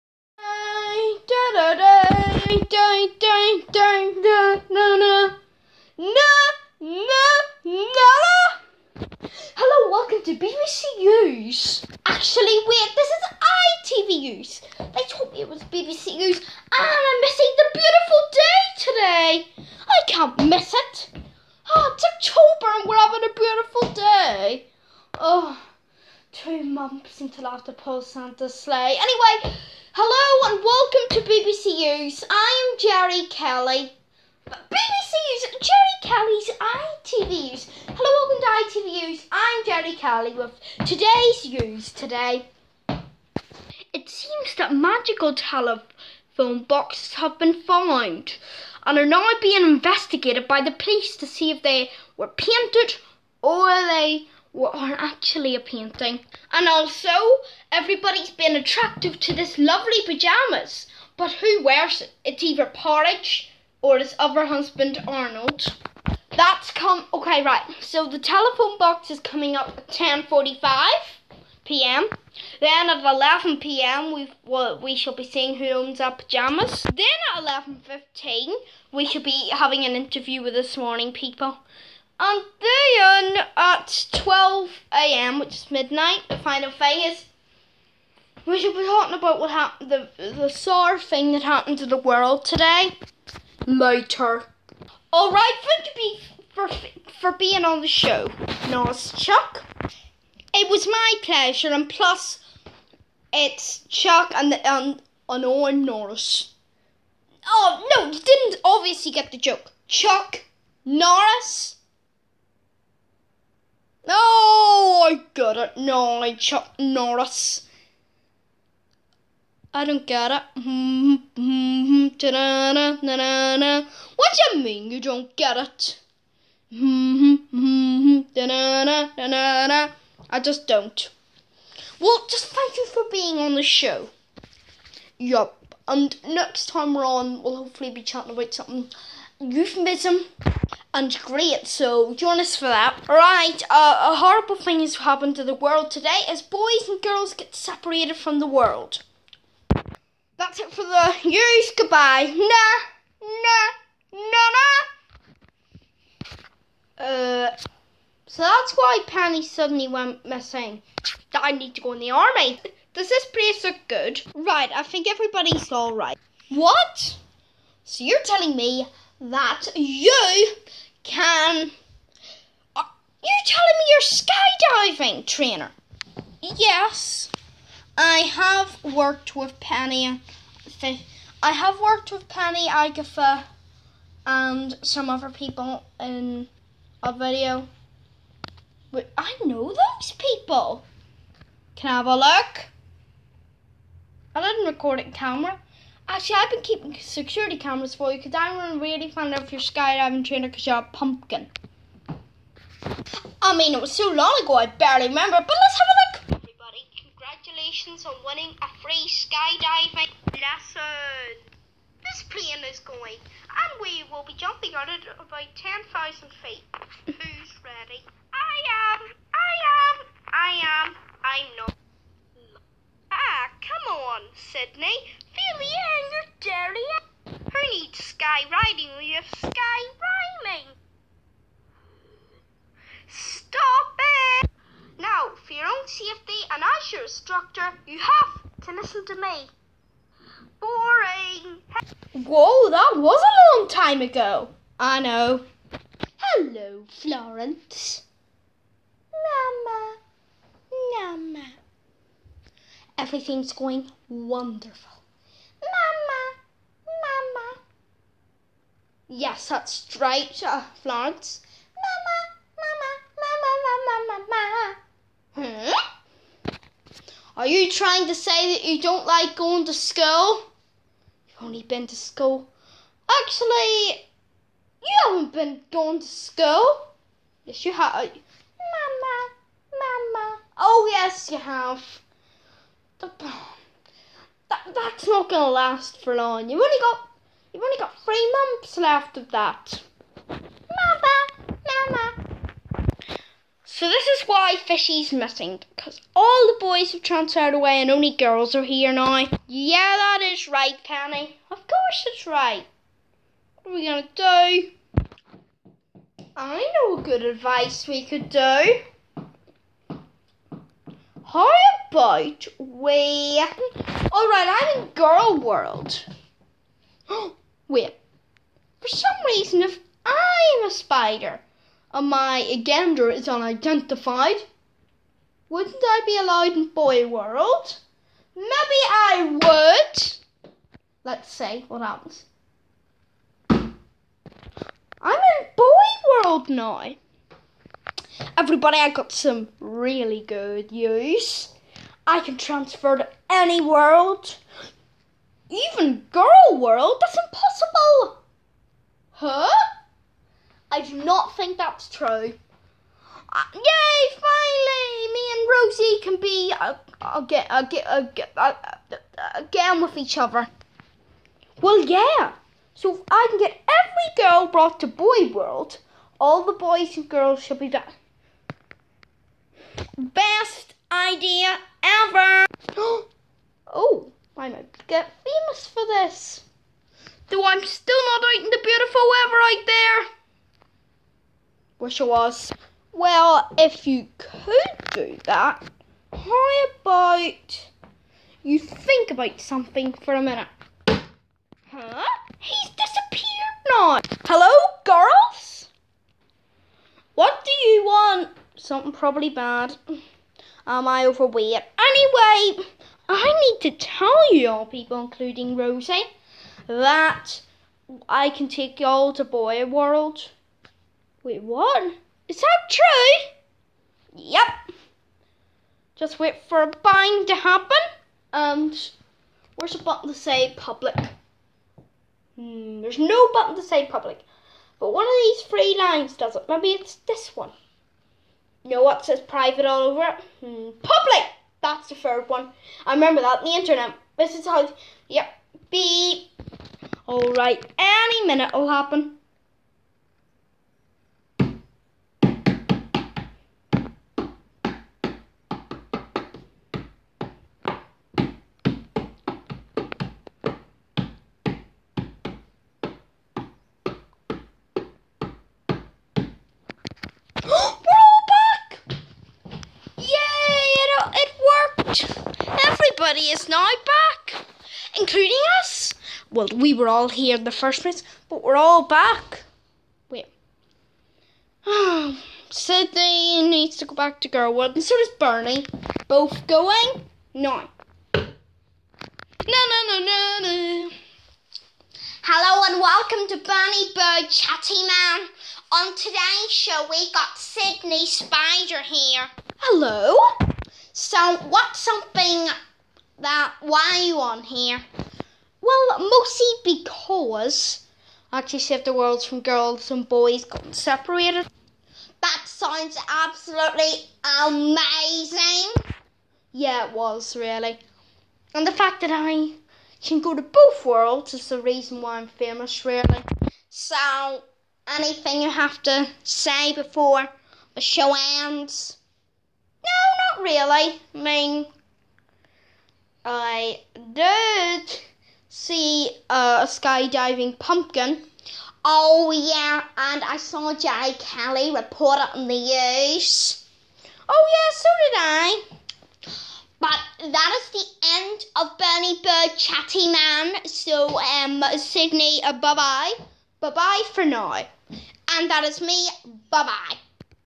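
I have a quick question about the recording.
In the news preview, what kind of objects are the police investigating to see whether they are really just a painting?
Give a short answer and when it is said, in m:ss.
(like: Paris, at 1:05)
Telephone boxes, at 0:45.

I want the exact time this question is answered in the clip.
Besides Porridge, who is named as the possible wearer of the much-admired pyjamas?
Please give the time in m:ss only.
1:05.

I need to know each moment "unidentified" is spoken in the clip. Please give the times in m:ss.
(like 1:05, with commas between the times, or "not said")
5:23.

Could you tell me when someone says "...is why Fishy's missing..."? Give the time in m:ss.
4:54.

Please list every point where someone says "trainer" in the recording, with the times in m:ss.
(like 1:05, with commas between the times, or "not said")
2:55, 3:20.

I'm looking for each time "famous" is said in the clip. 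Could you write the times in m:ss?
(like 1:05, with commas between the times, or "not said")
6:15, 8:32.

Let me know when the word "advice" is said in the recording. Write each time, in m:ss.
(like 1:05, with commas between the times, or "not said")
5:07.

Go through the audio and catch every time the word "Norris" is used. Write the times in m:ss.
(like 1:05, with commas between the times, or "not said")
1:45, 1:50, 1:56.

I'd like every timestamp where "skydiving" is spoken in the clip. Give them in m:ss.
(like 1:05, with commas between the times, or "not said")
2:55, 3:19, 3:29, 8:46.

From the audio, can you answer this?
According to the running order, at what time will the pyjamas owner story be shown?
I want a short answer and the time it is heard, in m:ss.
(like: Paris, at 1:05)
11 p.m., at 1:13.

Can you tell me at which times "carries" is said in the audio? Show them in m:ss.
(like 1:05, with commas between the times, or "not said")
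not said.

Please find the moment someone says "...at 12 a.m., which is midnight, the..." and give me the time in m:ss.
1:23.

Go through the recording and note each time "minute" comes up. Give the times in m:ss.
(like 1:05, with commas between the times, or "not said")
6:30, 7:18.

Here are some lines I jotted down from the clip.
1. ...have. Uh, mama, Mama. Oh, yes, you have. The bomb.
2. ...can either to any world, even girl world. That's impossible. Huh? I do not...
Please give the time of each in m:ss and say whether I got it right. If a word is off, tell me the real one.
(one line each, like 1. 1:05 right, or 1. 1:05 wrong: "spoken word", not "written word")
1. 4:37 right
2. 5:42 wrong: "transfer", not "either".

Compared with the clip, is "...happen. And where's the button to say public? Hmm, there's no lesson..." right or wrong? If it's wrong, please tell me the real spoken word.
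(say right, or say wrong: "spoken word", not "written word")
wrong: "button", not "lesson".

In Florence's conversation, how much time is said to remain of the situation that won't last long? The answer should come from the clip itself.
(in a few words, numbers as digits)
3 months.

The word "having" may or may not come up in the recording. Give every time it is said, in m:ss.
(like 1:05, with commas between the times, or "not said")
0:22, 1:19.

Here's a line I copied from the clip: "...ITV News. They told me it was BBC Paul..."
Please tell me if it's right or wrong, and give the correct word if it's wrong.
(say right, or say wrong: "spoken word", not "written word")
wrong: "News", not "Paul".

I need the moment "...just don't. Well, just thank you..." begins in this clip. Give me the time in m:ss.
2:10.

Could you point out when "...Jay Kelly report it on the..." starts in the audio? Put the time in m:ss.
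8:50.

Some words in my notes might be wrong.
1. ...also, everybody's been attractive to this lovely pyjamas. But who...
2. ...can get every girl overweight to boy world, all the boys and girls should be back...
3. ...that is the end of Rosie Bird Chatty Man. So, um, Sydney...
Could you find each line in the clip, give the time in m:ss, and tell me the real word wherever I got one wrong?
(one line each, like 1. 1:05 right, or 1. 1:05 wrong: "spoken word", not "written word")
1. 0:56 right
2. 6:03 wrong: "brought", not "overweight"
3. 8:57 wrong: "Bernie", not "Rosie".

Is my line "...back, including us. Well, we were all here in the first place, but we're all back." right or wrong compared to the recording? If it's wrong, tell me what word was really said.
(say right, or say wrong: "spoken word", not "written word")
right.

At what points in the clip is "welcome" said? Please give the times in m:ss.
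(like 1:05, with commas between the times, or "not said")
0:09, 0:30, 0:38, 8:02.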